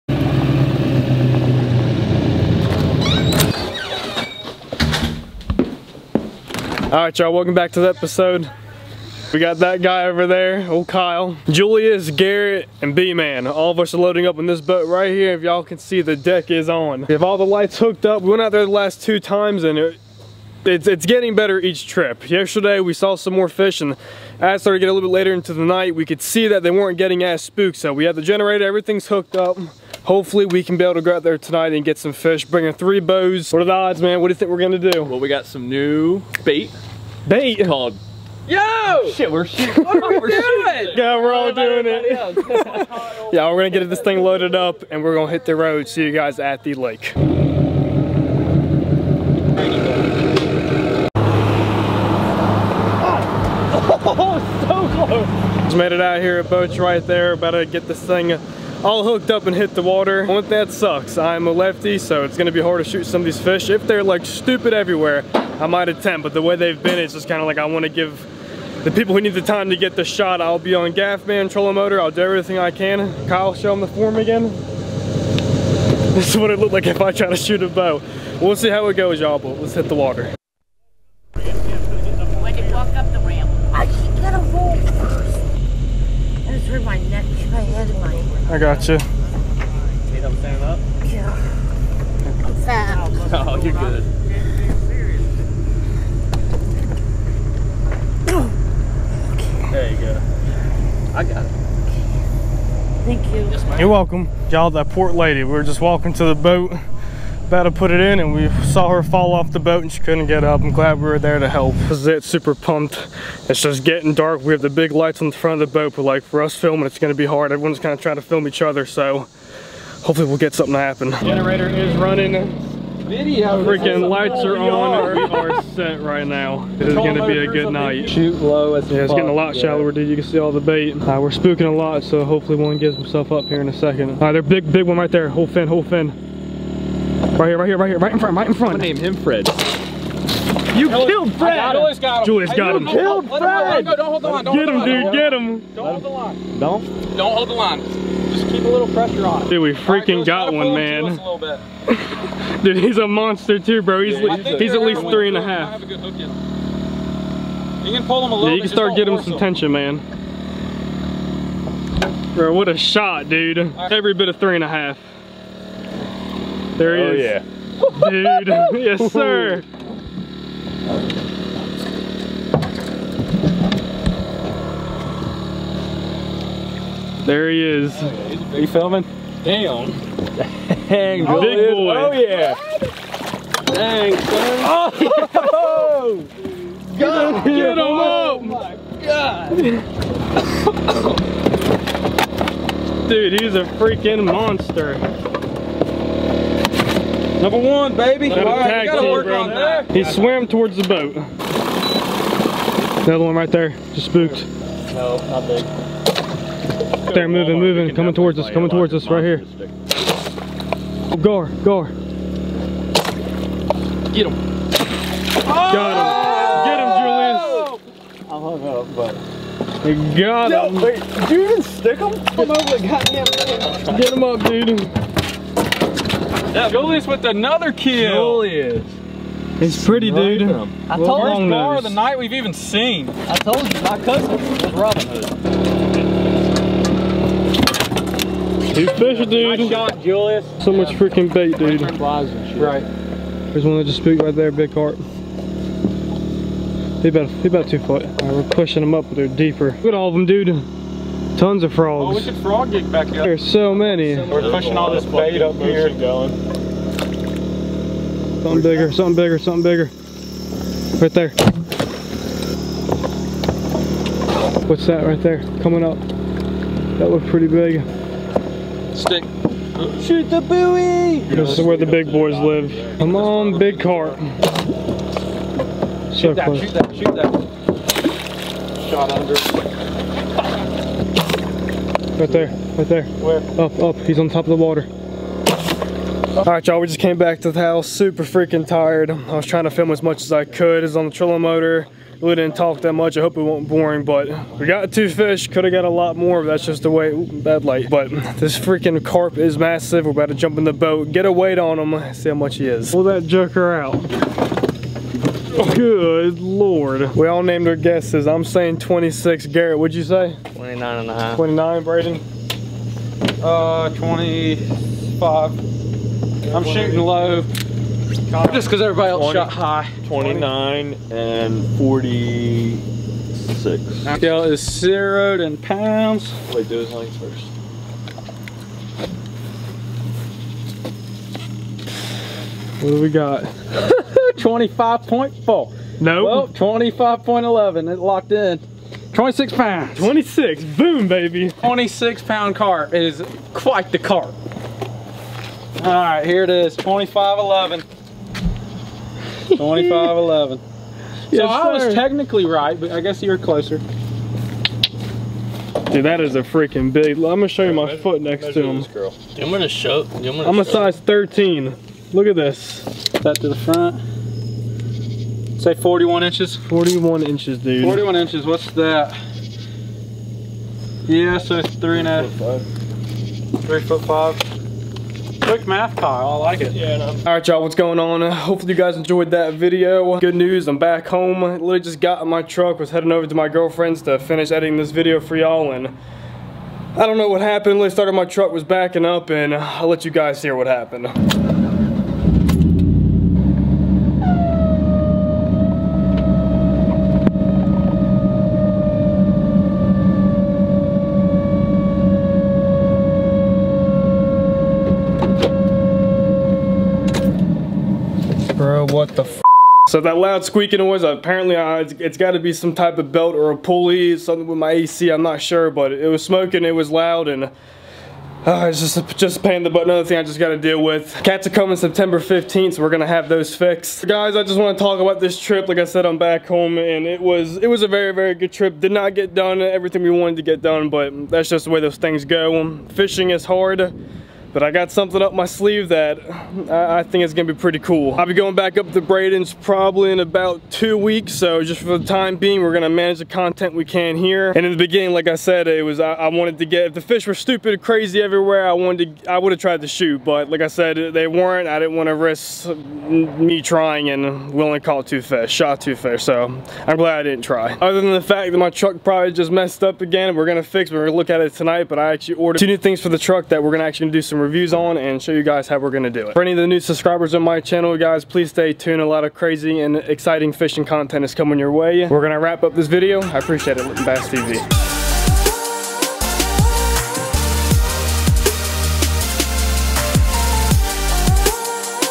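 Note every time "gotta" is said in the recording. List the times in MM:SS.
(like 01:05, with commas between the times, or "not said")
03:18.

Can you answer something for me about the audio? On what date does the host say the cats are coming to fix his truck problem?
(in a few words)
September 15th.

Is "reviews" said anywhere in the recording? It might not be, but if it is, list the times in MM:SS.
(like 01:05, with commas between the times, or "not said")
07:44.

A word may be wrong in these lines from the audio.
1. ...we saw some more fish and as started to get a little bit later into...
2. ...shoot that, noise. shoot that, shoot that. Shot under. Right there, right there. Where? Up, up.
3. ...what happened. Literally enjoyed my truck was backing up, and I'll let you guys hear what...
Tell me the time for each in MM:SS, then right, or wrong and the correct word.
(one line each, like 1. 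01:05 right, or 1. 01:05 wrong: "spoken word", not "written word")
1. 00:22 right
2. 04:36 wrong: "close", not "noise"
3. 06:27 wrong: "started", not "enjoyed".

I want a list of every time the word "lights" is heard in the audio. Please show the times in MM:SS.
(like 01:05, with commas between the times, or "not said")
00:17, 01:54, 02:04, 04:57.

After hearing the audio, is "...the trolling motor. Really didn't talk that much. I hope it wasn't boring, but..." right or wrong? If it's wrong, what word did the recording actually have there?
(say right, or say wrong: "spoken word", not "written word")
right.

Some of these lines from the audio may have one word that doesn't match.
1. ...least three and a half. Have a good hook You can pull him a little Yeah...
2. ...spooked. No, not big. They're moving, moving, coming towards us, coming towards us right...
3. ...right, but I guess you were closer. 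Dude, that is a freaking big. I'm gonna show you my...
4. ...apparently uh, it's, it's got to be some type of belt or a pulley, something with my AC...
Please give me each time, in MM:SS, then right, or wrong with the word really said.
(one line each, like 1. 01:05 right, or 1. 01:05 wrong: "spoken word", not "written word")
1. 02:34 right
2. 03:24 right
3. 05:52 right
4. 06:51 right.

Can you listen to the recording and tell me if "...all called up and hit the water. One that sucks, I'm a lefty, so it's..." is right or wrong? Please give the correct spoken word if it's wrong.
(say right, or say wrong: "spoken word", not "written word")
wrong: "hooked", not "called".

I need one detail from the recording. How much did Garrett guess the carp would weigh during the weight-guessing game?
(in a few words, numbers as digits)
29 and a half.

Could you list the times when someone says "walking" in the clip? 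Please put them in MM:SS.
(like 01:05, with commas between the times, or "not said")
01:45.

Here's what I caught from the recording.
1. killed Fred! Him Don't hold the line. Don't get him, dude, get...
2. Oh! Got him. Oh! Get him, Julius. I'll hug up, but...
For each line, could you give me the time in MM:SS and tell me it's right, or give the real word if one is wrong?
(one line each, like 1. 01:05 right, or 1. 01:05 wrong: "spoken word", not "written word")
1. 02:22 right
2. 03:35 right.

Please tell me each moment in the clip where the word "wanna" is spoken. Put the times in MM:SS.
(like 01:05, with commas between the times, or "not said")
01:07, 07:31.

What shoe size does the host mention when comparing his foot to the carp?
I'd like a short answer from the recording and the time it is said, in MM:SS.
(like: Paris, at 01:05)
13, at 06:01.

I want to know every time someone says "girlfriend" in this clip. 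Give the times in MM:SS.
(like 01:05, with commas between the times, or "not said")
06:23.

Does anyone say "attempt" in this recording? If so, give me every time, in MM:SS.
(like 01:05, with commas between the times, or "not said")
01:05.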